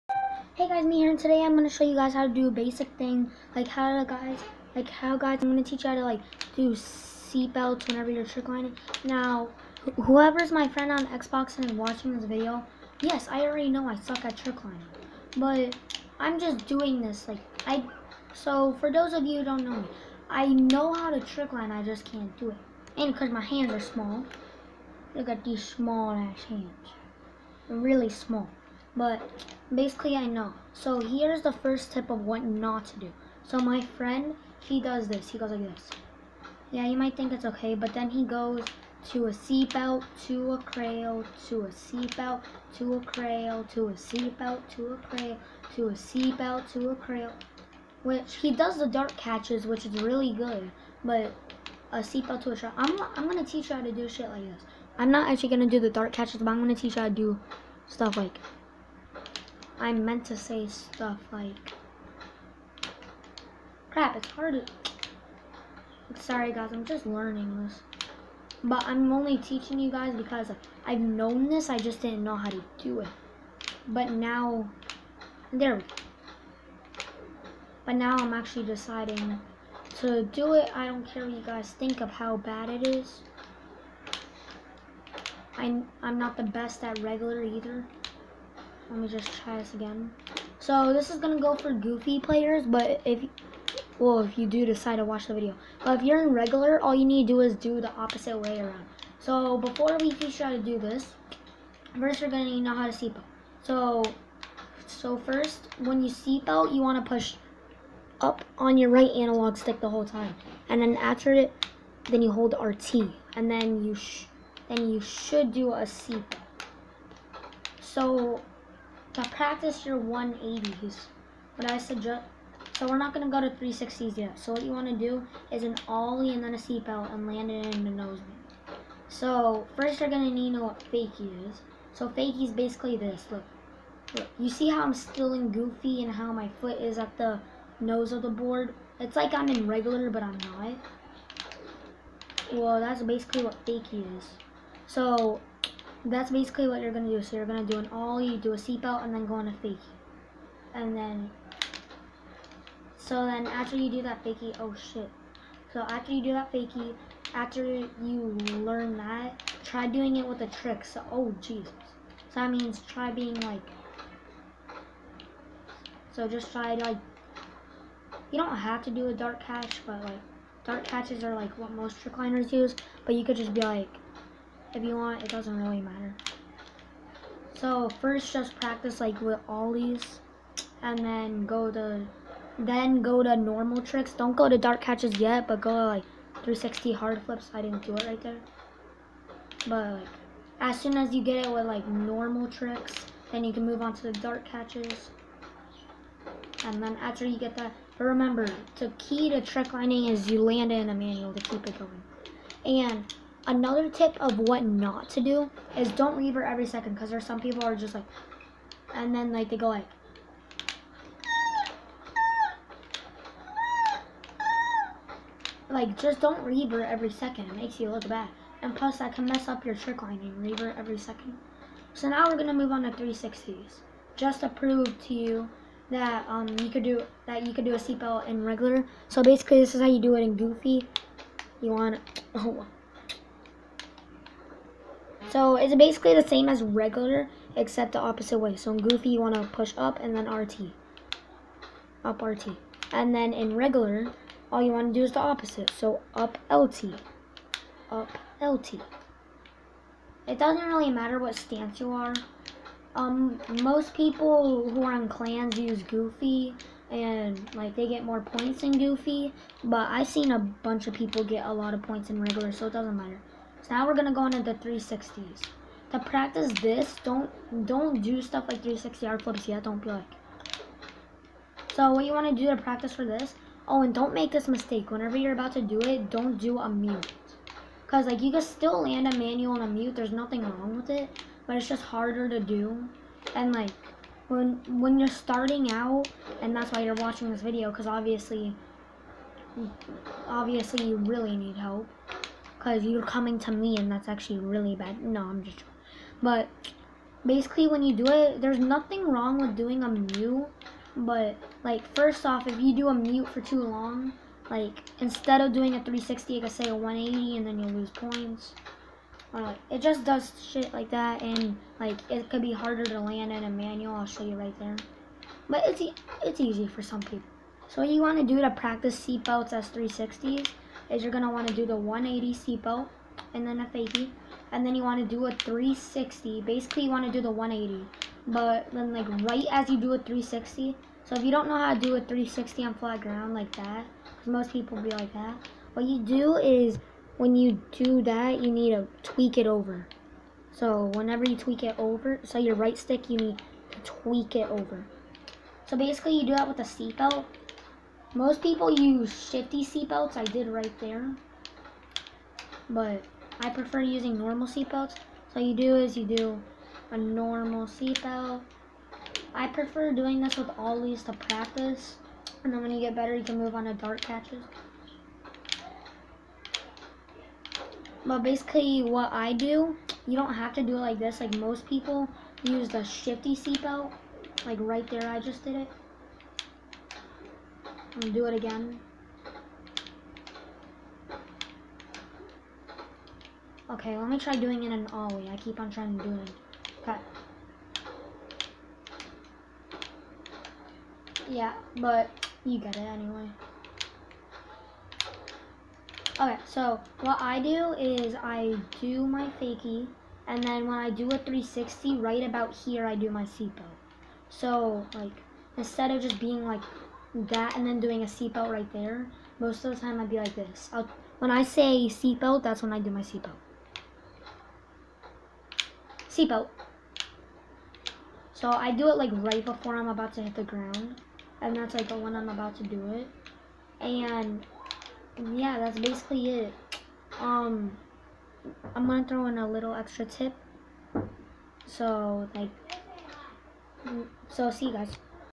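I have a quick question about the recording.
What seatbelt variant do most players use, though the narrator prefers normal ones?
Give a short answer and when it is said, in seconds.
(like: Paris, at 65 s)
shifty seatbelt, at 349 s.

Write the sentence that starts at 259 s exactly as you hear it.
But I've seen a bunch of people get a lot of points in regular, so it doesn't matter.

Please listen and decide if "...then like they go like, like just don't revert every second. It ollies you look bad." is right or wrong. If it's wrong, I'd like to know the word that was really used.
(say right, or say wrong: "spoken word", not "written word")
wrong: "makes", not "ollies".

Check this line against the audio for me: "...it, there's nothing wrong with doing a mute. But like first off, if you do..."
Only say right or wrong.
right.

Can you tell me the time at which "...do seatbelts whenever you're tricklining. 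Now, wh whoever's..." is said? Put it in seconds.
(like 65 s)
6 s.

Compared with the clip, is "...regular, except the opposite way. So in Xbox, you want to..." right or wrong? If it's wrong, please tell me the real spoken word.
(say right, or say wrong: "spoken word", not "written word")
wrong: "Goofy", not "Xbox".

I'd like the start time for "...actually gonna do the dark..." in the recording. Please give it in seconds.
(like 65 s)
55 s.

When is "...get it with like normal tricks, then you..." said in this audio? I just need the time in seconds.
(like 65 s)
191 s.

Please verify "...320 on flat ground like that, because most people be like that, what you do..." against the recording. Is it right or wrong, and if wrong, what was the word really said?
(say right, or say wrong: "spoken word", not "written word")
wrong: "360", not "320".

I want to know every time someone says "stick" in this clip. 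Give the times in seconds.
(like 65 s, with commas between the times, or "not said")
109 s, 342 s.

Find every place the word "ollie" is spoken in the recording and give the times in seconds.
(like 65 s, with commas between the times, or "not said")
125 s, 147 s, 179 s, 360 s, 384 s.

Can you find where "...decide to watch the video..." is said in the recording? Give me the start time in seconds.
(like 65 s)
94 s.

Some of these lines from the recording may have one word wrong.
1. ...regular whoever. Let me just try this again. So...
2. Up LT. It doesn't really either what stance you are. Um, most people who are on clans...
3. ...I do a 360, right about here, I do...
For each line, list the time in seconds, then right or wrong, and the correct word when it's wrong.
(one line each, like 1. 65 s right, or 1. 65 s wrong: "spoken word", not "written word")
1. 86 s wrong: "either", not "whoever"
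2. 247 s wrong: "matter", not "either"
3. 400 s right.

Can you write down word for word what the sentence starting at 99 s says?
So before we teach you how to do this, first you're gonna need to know how to seatbelt.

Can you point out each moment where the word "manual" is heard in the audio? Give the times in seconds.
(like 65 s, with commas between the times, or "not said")
200 s, 279 s, 313 s.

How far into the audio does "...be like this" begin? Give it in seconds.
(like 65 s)
410 s.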